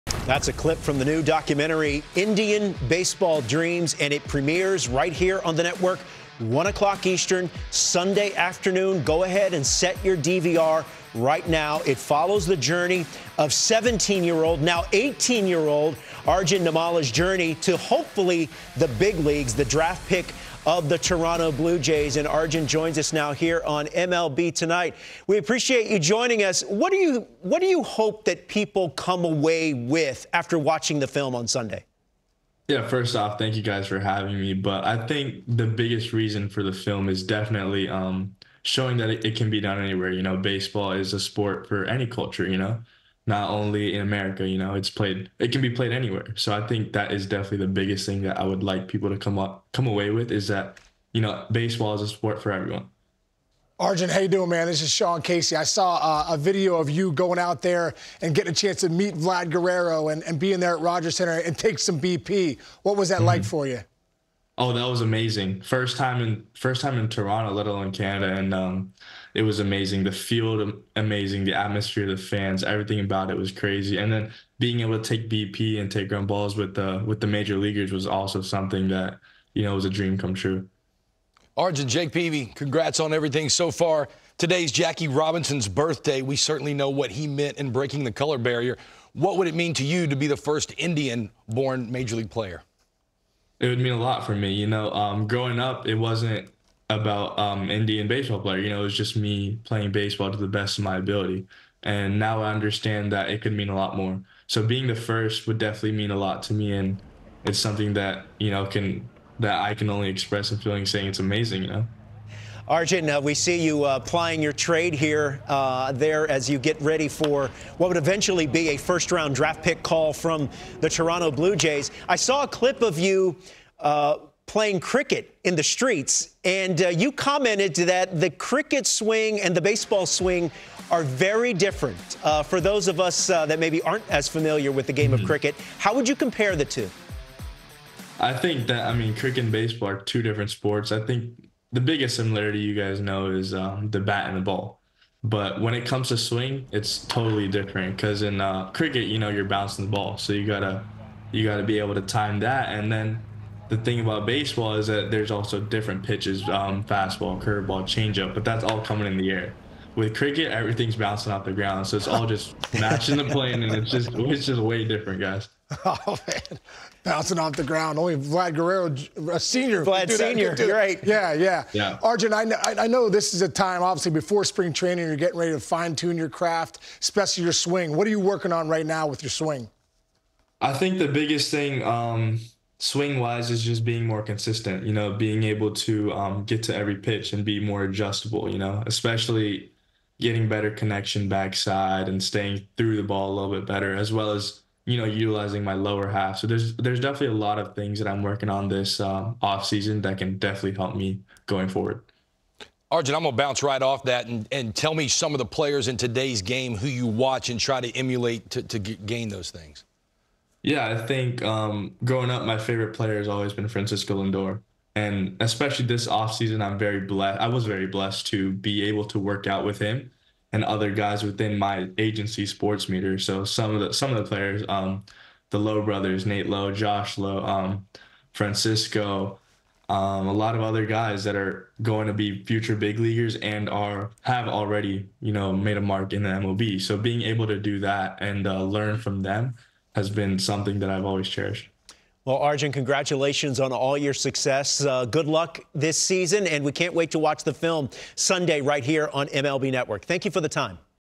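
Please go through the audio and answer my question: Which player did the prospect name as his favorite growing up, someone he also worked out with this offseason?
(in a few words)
Francisco Lindor.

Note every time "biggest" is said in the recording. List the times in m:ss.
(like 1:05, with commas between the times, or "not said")
0:35, 0:47, 2:21, 3:01.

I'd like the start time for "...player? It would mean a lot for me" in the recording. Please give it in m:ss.
1:32.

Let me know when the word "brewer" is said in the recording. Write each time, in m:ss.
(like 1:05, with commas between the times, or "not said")
not said.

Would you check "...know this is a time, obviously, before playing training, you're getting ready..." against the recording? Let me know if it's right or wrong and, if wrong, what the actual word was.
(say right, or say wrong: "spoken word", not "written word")
wrong: "spring", not "playing".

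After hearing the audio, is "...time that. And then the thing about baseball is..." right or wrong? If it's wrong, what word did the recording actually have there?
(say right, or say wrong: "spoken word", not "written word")
right.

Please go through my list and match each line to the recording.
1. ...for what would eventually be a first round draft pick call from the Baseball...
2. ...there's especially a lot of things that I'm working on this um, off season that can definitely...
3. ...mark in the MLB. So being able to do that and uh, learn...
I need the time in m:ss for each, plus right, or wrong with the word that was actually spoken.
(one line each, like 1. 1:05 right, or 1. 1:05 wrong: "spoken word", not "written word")
1. 1:57 wrong: "Toronto", not "Baseball"
2. 3:16 wrong: "definitely", not "especially"
3. 3:55 right.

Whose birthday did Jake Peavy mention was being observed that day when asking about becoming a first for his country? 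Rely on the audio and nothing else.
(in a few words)
Jackie Robinson.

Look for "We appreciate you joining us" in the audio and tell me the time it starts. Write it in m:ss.
0:25.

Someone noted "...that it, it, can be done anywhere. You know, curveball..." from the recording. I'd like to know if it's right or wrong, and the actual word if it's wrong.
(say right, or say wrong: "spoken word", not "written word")
wrong: "baseball", not "curveball".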